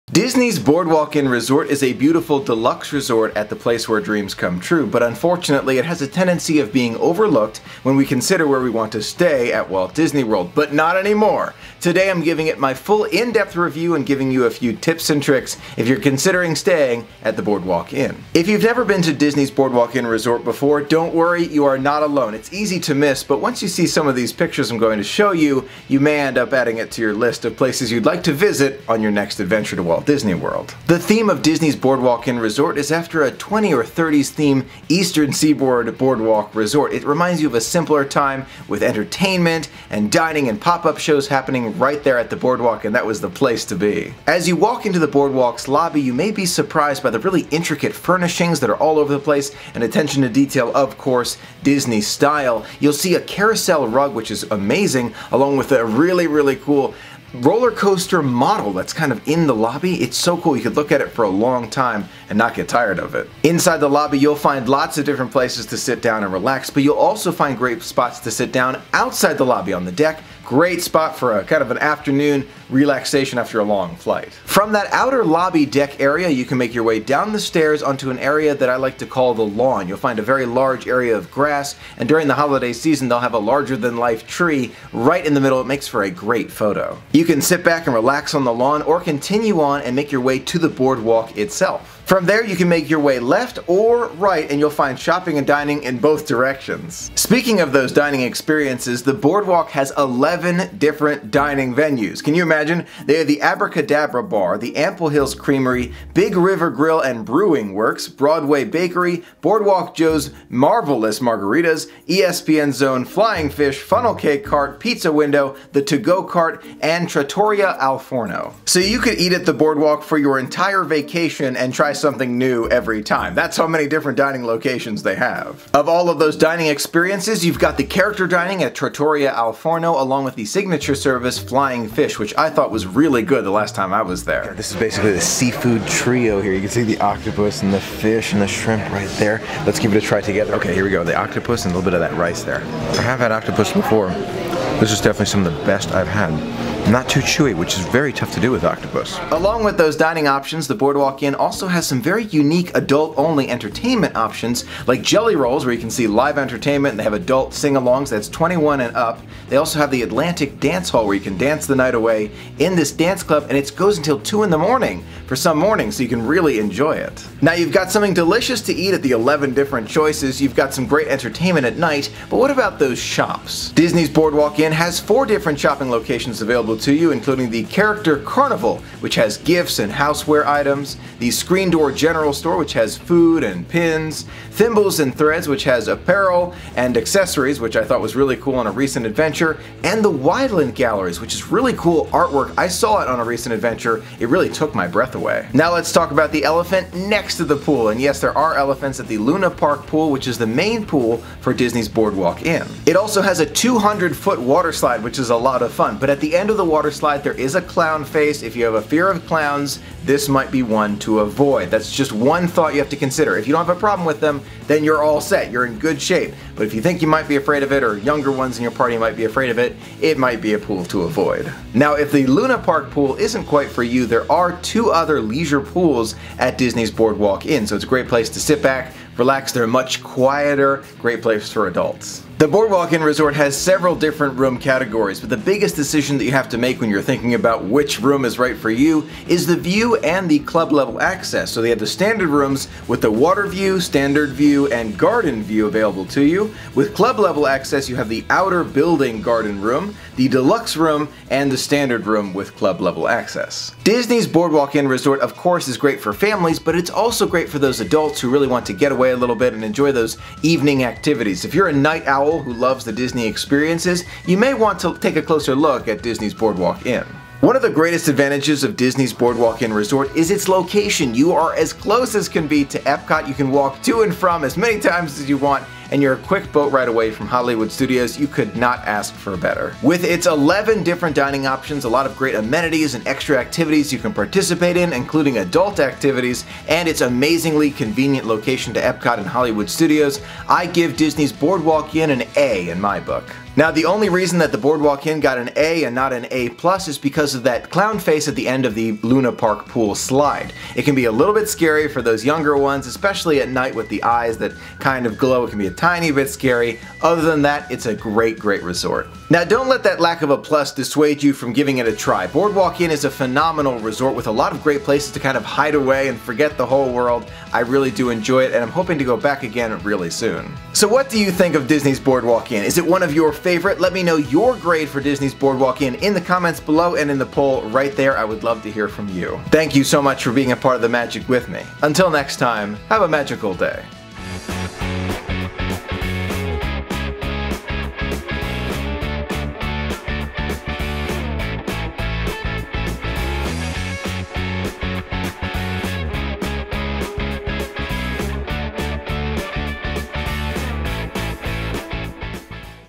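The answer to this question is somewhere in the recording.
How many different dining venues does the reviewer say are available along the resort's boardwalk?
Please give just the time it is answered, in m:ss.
1:39.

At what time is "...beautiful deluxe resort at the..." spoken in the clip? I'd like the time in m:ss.
0:01.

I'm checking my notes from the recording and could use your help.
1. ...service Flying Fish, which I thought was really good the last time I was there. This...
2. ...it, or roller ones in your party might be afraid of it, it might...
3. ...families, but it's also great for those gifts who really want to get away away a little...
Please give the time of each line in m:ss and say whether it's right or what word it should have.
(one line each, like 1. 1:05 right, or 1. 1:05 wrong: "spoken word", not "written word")
1. 2:10 right
2. 3:37 wrong: "younger", not "roller"
3. 4:16 wrong: "adults", not "gifts".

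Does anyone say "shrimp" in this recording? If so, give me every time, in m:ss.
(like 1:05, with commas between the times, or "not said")
2:18.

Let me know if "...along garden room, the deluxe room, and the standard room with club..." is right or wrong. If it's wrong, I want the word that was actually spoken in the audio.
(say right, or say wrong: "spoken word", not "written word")
wrong: "building", not "along".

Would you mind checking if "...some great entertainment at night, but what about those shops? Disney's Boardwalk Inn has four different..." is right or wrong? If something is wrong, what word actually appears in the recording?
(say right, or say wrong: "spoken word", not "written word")
right.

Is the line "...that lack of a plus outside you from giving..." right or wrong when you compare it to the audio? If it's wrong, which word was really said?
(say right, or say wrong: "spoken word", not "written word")
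wrong: "dissuade", not "outside".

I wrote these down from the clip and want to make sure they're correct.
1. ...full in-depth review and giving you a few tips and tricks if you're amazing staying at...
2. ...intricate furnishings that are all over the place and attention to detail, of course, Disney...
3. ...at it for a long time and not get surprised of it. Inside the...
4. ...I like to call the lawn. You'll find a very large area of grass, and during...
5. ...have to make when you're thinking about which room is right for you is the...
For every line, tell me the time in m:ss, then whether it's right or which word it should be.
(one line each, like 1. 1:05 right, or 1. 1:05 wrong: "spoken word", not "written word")
1. 0:12 wrong: "considering", not "amazing"
2. 0:47 right
3. 1:00 wrong: "tired", not "surprised"
4. 1:18 right
5. 3:56 right.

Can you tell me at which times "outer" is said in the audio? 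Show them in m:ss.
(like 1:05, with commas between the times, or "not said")
1:14, 4:08.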